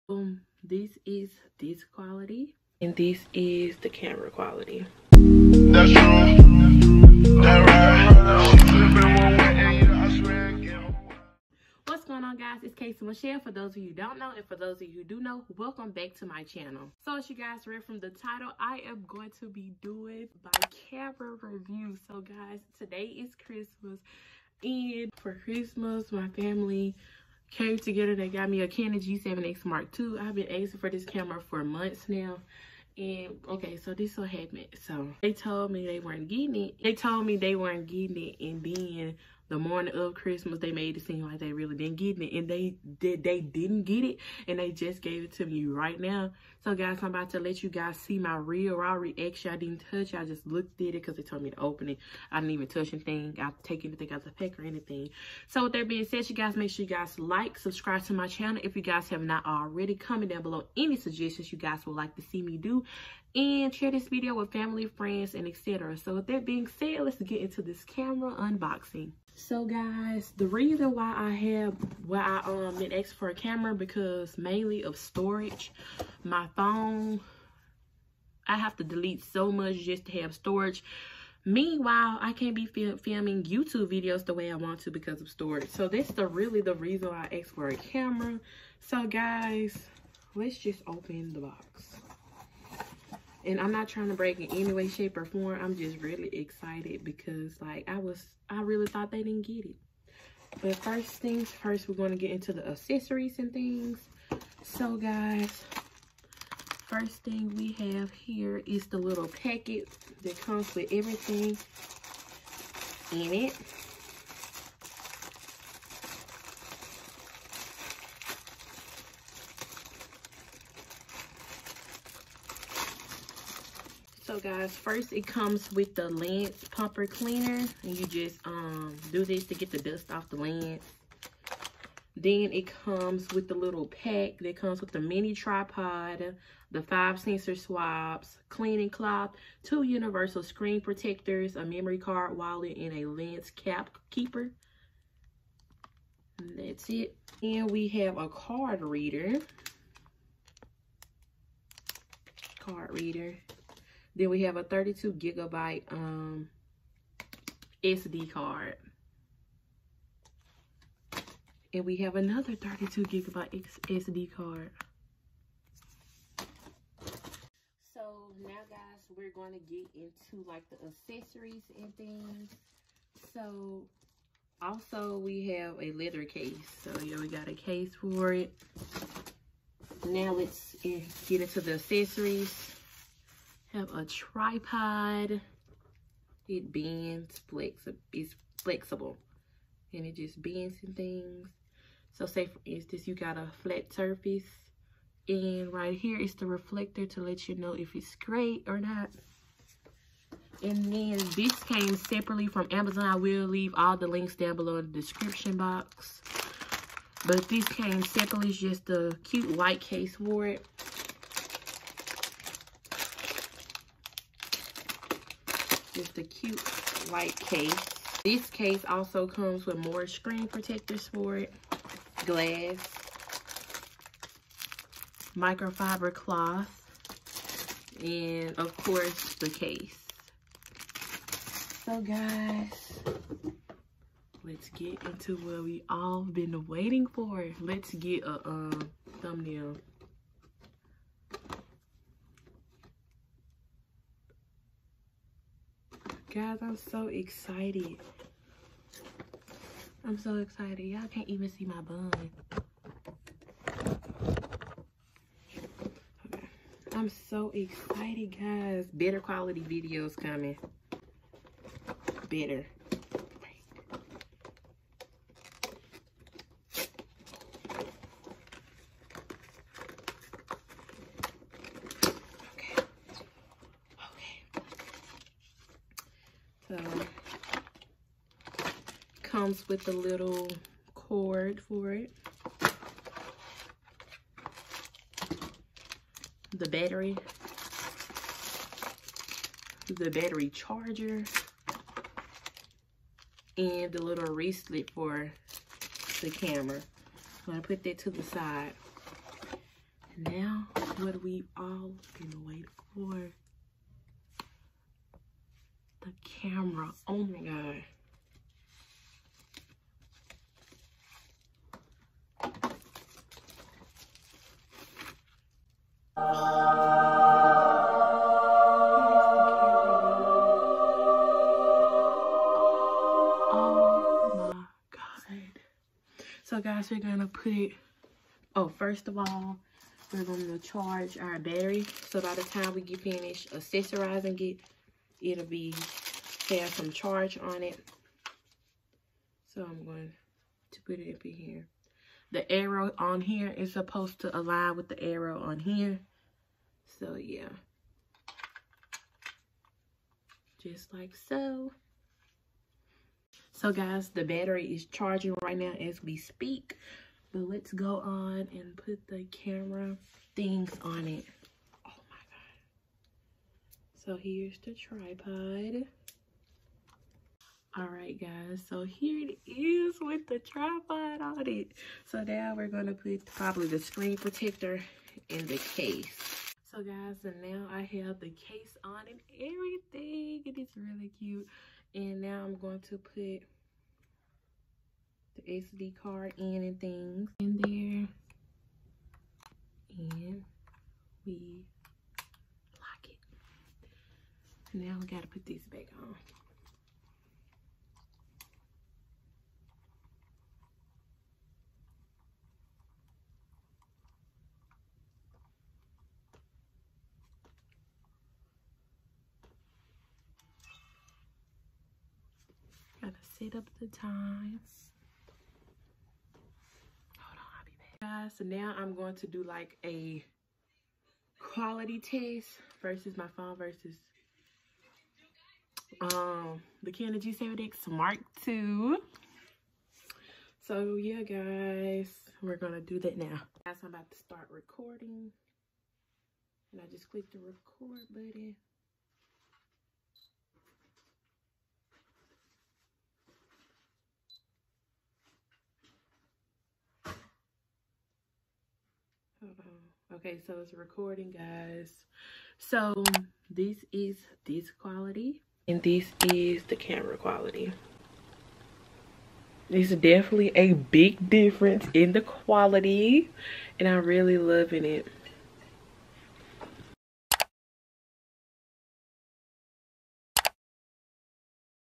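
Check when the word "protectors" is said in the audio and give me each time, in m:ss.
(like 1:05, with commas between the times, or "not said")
2:20, 3:40, 6:14.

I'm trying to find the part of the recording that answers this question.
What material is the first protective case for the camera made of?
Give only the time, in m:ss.
2:55.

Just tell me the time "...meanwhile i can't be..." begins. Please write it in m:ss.
1:21.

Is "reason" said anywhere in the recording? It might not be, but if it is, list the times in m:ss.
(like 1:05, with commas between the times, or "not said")
1:10, 1:26.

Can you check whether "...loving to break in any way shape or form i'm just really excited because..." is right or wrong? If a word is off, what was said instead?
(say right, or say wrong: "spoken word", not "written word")
wrong: "trying", not "loving".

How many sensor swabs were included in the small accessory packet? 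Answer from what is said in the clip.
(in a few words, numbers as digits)
5.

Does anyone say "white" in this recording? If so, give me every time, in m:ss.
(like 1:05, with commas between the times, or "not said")
3:29, 3:37.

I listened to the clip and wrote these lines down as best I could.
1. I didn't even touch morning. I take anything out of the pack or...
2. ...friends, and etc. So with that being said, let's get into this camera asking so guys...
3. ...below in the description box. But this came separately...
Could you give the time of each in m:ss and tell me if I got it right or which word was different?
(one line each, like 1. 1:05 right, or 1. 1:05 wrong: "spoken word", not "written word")
1. 0:52 wrong: "anything", not "morning"
2. 1:04 wrong: "unboxing", not "asking"
3. 3:24 right.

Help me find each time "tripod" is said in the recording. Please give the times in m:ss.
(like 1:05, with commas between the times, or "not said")
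2:15, 3:04, 6:04, 6:10.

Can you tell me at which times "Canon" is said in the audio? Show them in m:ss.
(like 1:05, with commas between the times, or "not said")
0:28, 7:06.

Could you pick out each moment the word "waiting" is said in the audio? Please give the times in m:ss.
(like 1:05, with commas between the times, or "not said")
3:56, 5:02.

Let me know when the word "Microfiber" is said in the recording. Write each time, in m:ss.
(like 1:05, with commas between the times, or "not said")
3:45.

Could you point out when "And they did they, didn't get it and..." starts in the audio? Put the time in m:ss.
0:42.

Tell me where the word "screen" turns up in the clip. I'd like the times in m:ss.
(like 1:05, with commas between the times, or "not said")
2:20, 3:40, 6:13.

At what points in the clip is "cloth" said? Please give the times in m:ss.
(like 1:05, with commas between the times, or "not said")
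2:18, 3:46.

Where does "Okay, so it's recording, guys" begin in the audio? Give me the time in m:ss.
7:30.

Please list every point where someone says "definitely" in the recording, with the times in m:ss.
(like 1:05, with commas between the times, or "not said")
7:39.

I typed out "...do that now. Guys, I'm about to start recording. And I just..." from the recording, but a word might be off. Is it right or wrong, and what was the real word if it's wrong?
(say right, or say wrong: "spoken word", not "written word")
right.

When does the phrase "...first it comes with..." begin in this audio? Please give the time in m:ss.
2:04.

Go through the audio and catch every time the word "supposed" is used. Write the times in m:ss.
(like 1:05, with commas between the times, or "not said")
5:43.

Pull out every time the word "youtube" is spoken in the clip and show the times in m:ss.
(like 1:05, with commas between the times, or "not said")
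1:23.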